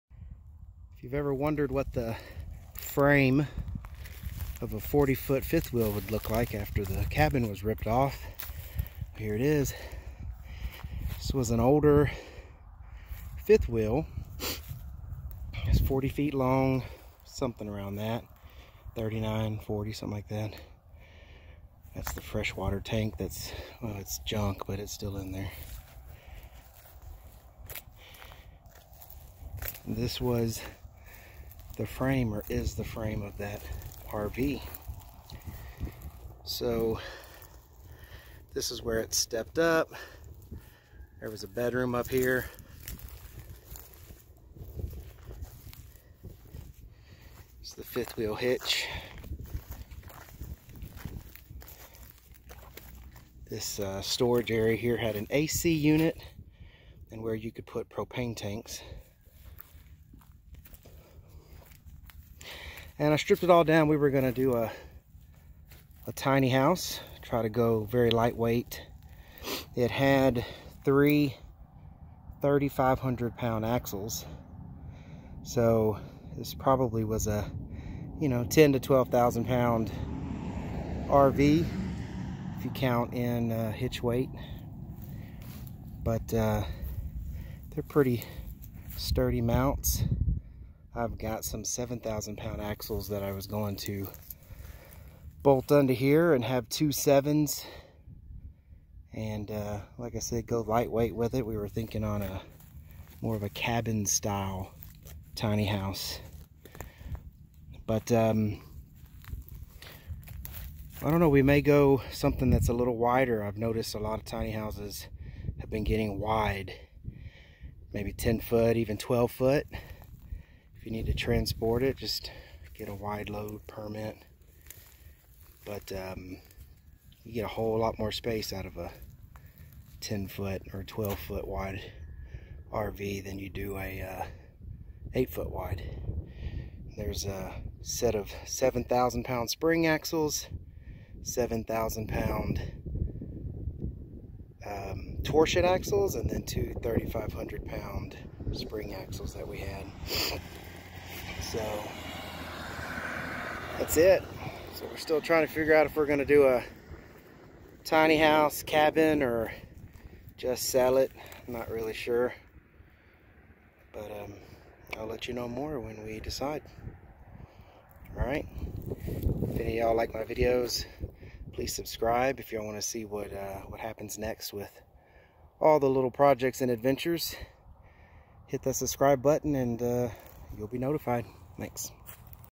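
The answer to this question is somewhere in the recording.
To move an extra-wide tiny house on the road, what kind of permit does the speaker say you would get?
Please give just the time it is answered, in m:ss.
2:02.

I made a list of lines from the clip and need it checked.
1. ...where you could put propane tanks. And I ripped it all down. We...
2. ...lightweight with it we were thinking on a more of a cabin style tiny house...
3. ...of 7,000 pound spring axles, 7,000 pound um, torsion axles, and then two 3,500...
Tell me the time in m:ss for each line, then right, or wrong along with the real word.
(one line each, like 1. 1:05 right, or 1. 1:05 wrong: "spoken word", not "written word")
1. 0:57 wrong: "stripped", not "ripped"
2. 1:40 right
3. 2:18 right.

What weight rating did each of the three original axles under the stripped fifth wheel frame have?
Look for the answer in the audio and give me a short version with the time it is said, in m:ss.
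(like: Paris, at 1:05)
3,500 pounds, at 1:10.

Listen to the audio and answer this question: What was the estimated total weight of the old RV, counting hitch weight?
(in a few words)
10 to 12,000 pounds.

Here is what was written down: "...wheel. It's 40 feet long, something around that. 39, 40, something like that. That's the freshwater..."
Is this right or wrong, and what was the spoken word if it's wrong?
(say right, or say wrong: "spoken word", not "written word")
right.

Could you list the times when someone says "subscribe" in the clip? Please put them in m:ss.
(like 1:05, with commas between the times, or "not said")
2:51, 2:58.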